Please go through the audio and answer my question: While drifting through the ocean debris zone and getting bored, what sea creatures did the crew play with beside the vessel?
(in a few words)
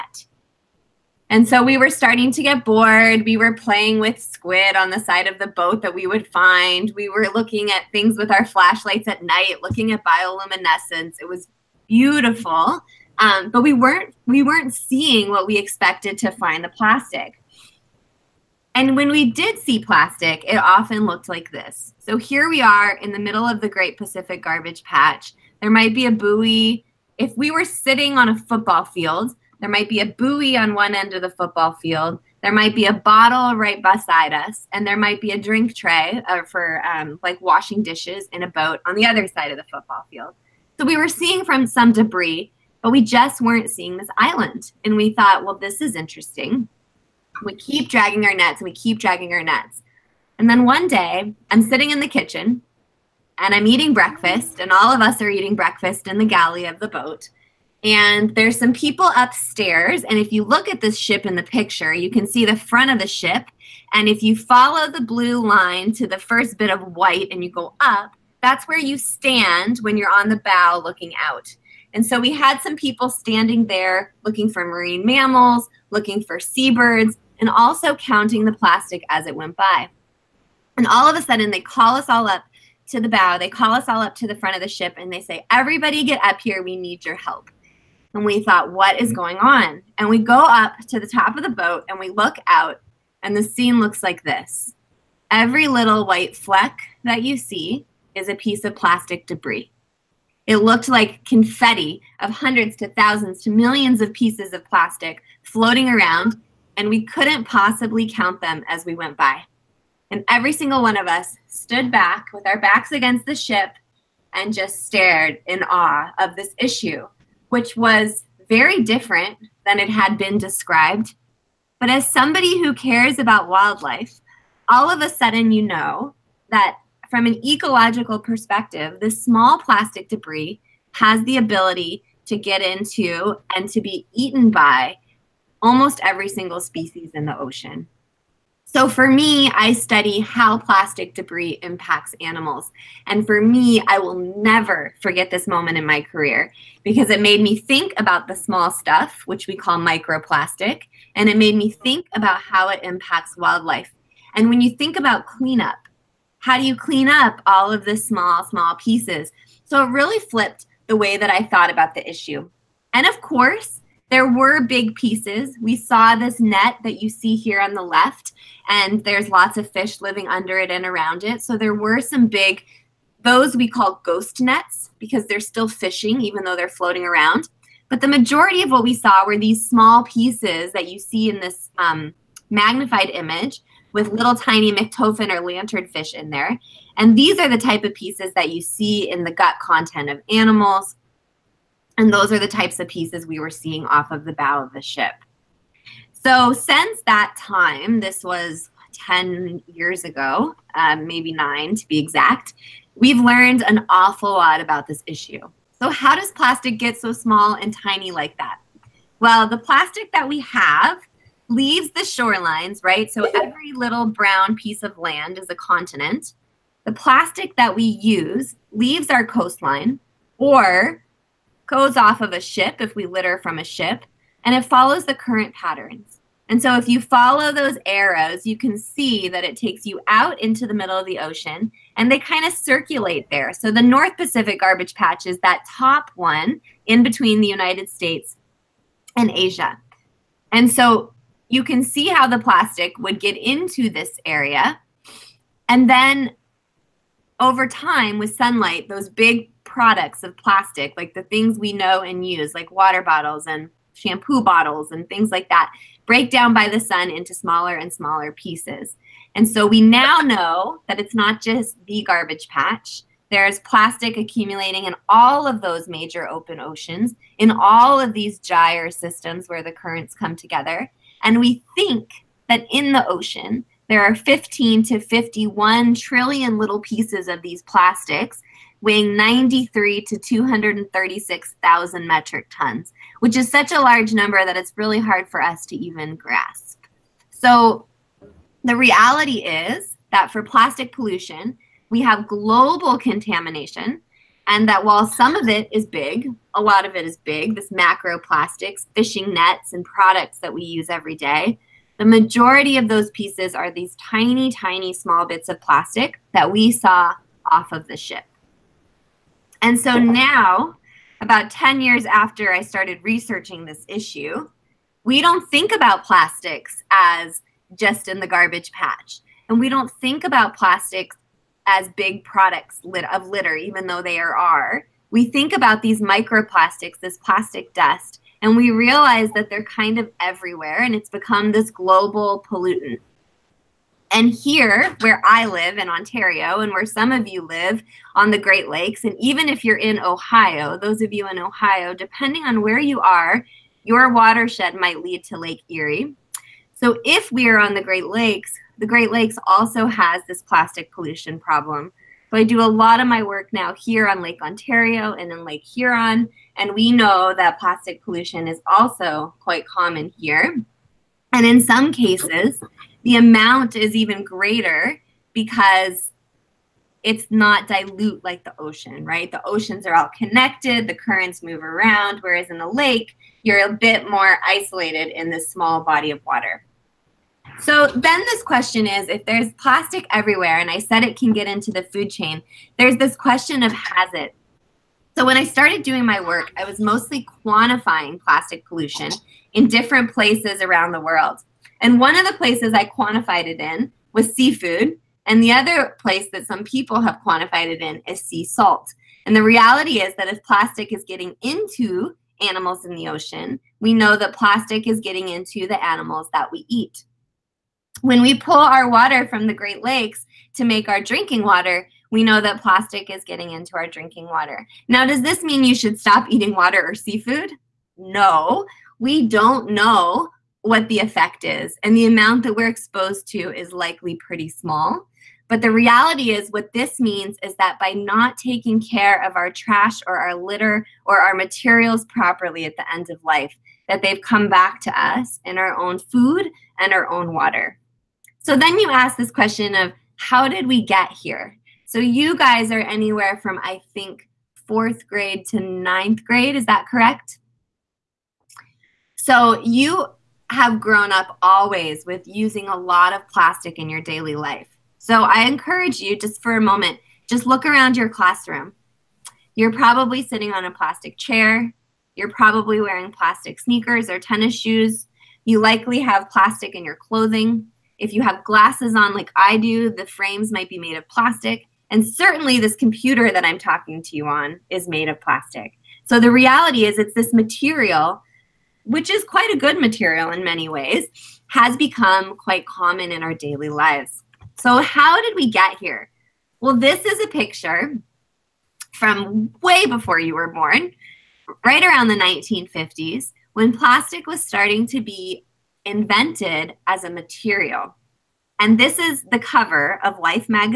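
squid.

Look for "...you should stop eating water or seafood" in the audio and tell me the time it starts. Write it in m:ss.
6:55.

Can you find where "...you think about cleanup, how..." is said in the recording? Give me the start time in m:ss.
2:34.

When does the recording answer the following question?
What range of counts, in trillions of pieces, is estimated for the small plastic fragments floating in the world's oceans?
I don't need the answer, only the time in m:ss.
4:34.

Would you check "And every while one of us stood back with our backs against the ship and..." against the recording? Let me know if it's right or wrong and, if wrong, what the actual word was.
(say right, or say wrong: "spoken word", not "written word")
wrong: "single", not "while".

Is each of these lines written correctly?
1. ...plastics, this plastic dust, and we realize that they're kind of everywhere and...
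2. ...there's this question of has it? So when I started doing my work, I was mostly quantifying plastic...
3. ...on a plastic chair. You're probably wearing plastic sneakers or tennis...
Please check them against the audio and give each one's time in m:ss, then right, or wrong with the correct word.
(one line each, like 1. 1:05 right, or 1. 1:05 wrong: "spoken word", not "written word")
1. 5:26 wrong: "microplastics", not "plastics"
2. 6:22 right
3. 7:40 right.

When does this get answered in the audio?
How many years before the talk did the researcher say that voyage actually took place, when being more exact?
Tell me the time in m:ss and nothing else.
3:21.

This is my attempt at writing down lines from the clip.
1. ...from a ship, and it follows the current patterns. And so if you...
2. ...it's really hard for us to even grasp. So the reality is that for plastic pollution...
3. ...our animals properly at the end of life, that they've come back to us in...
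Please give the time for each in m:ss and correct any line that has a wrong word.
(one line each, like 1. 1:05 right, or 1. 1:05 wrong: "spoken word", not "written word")
1. 3:43 right
2. 4:44 right
3. 7:11 wrong: "materials", not "animals".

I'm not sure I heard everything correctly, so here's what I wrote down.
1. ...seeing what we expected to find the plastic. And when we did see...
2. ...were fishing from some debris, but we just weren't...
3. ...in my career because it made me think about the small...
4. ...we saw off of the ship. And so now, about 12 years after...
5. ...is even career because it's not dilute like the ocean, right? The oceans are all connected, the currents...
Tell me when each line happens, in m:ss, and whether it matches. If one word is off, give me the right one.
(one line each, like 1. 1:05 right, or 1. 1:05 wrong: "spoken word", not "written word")
1. 0:14 right
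2. 0:40 wrong: "seeing", not "fishing"
3. 2:25 right
4. 5:06 wrong: "10", not "12"
5. 6:03 wrong: "greater", not "career".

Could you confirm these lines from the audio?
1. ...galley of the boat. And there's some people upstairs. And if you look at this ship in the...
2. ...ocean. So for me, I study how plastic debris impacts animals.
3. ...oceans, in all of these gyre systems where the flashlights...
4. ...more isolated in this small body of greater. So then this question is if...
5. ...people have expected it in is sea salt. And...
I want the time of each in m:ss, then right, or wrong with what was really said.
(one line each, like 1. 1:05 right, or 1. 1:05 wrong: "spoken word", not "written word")
1. 0:56 right
2. 2:17 right
3. 4:26 wrong: "currents", not "flashlights"
4. 6:14 wrong: "water", not "greater"
5. 6:36 wrong: "quantified", not "expected".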